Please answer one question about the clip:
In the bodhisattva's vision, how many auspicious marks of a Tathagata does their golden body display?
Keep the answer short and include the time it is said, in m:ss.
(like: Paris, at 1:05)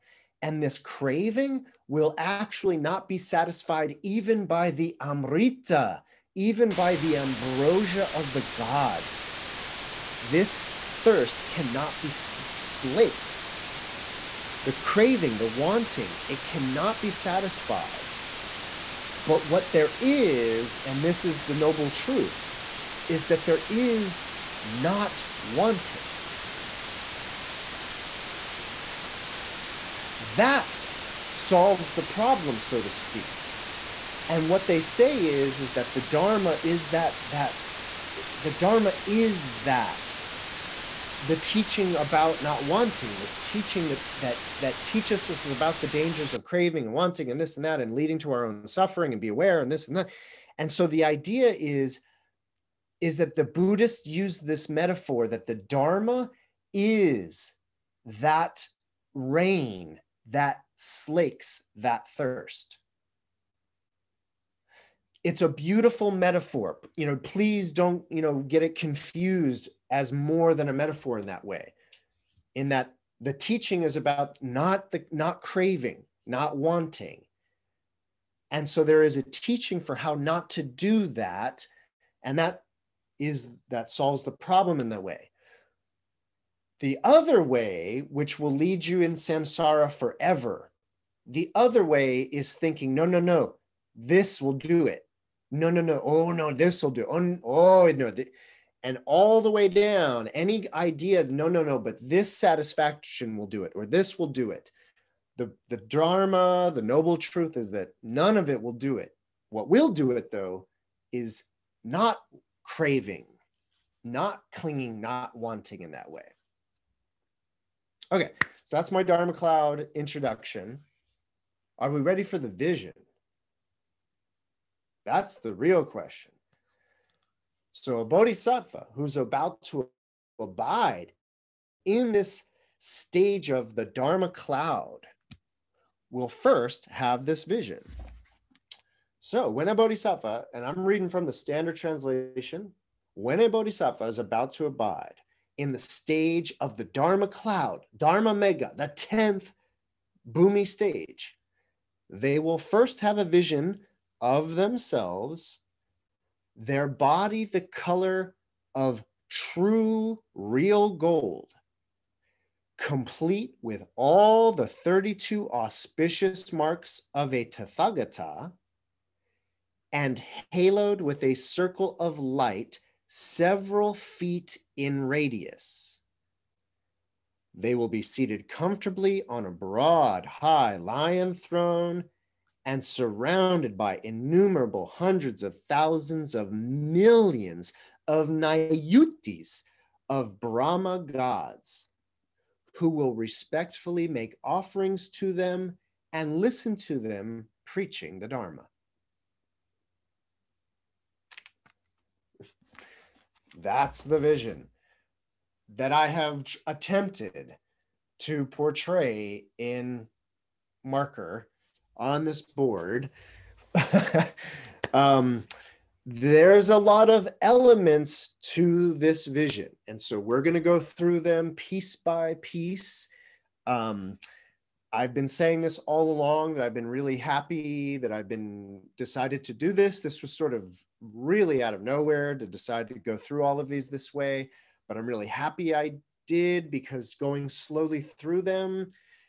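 32, at 2:44.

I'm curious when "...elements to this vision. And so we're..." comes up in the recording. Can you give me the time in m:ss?
3:37.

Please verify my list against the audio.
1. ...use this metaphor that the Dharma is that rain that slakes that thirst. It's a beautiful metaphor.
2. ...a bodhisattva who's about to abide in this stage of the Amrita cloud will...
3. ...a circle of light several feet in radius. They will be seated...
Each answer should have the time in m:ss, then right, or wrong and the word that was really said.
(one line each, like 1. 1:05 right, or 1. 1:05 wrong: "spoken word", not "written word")
1. 0:54 right
2. 2:08 wrong: "Dharma", not "Amrita"
3. 2:51 right.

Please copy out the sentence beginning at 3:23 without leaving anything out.
That's the vision that I have attempted to portray in marker on this board.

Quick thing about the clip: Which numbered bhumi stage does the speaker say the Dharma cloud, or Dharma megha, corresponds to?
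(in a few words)
10th.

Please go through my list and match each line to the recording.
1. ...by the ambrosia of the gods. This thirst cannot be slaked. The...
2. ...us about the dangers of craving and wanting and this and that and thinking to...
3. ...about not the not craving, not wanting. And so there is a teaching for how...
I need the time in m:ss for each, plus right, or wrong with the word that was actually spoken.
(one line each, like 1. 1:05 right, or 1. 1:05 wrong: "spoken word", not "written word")
1. 0:06 right
2. 0:45 wrong: "leading", not "thinking"
3. 1:13 right.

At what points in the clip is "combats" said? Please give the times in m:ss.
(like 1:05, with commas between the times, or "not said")
not said.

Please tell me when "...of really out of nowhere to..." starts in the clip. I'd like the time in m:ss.
3:50.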